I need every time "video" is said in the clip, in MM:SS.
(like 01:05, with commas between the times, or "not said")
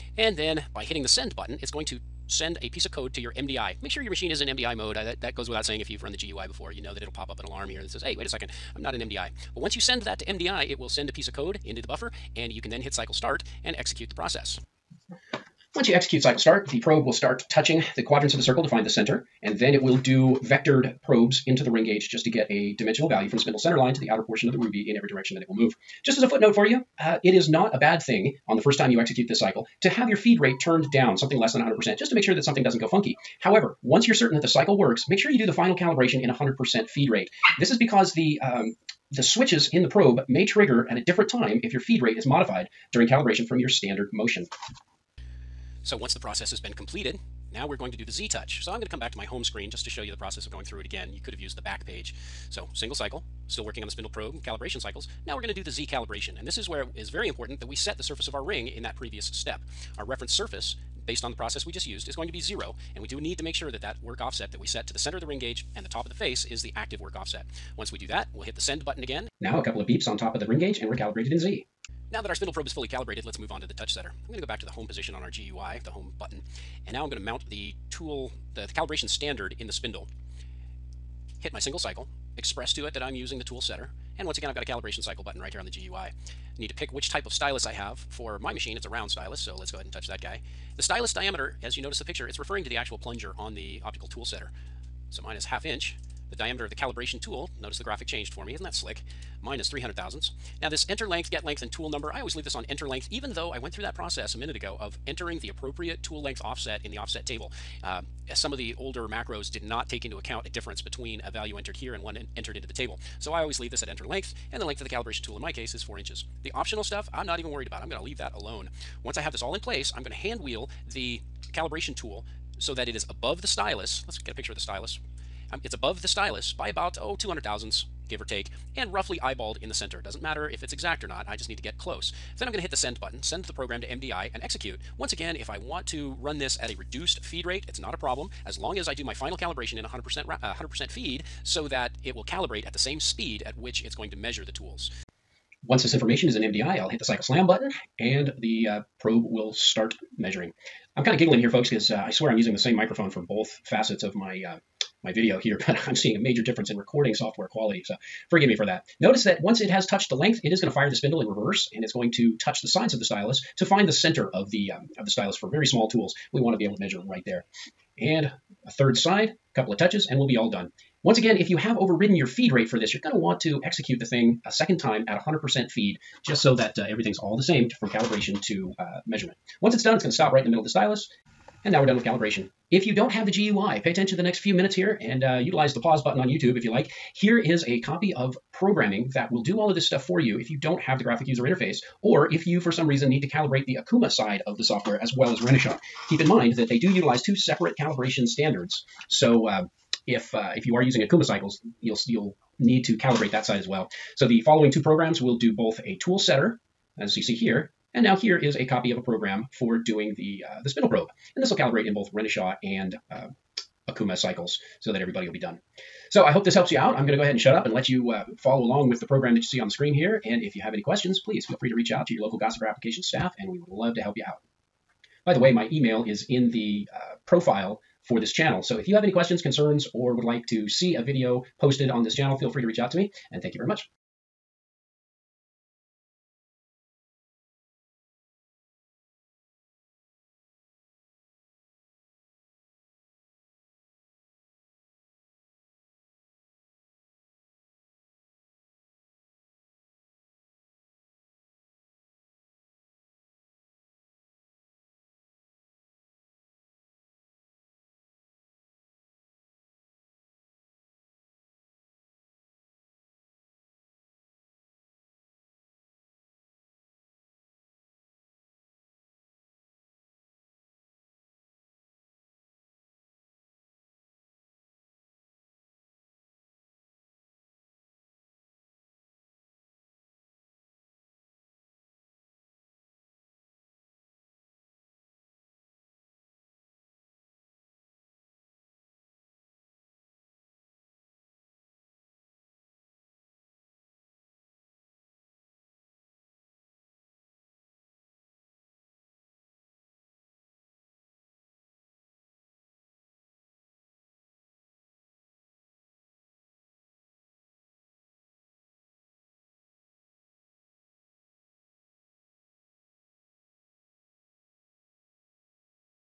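02:35, 03:51.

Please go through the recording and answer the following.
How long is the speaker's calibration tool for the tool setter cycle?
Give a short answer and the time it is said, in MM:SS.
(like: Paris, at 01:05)
4 inches, at 01:55.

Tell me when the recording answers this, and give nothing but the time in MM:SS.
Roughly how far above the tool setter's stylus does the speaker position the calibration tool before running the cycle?
02:07.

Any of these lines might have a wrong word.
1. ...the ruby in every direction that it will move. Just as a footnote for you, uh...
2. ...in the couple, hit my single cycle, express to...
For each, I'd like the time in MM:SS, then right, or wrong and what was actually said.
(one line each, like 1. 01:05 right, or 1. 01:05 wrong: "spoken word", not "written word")
1. 00:24 right
2. 01:19 wrong: "spindle", not "couple".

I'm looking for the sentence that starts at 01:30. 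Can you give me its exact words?
The stylus diameter, as you notice the picture, it's referring to the actual plunger on the optical tool setter.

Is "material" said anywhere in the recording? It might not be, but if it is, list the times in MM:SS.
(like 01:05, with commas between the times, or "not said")
not said.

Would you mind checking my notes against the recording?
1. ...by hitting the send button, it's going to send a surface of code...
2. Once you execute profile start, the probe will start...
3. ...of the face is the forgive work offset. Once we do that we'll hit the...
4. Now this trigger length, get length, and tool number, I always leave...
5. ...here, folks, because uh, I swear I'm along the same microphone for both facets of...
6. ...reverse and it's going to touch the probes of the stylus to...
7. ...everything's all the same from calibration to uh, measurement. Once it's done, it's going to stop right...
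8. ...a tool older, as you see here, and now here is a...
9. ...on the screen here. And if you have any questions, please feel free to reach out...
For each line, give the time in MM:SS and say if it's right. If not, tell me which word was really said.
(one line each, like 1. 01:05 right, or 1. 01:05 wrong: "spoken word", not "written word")
1. 00:00 wrong: "piece", not "surface"
2. 00:15 wrong: "cycle", not "profile"
3. 01:06 wrong: "active", not "forgive"
4. 01:40 wrong: "enter", not "trigger"
5. 02:31 wrong: "using", not "along"
6. 02:41 wrong: "sides", not "probes"
7. 02:56 right
8. 03:25 wrong: "setter", not "older"
9. 03:39 right.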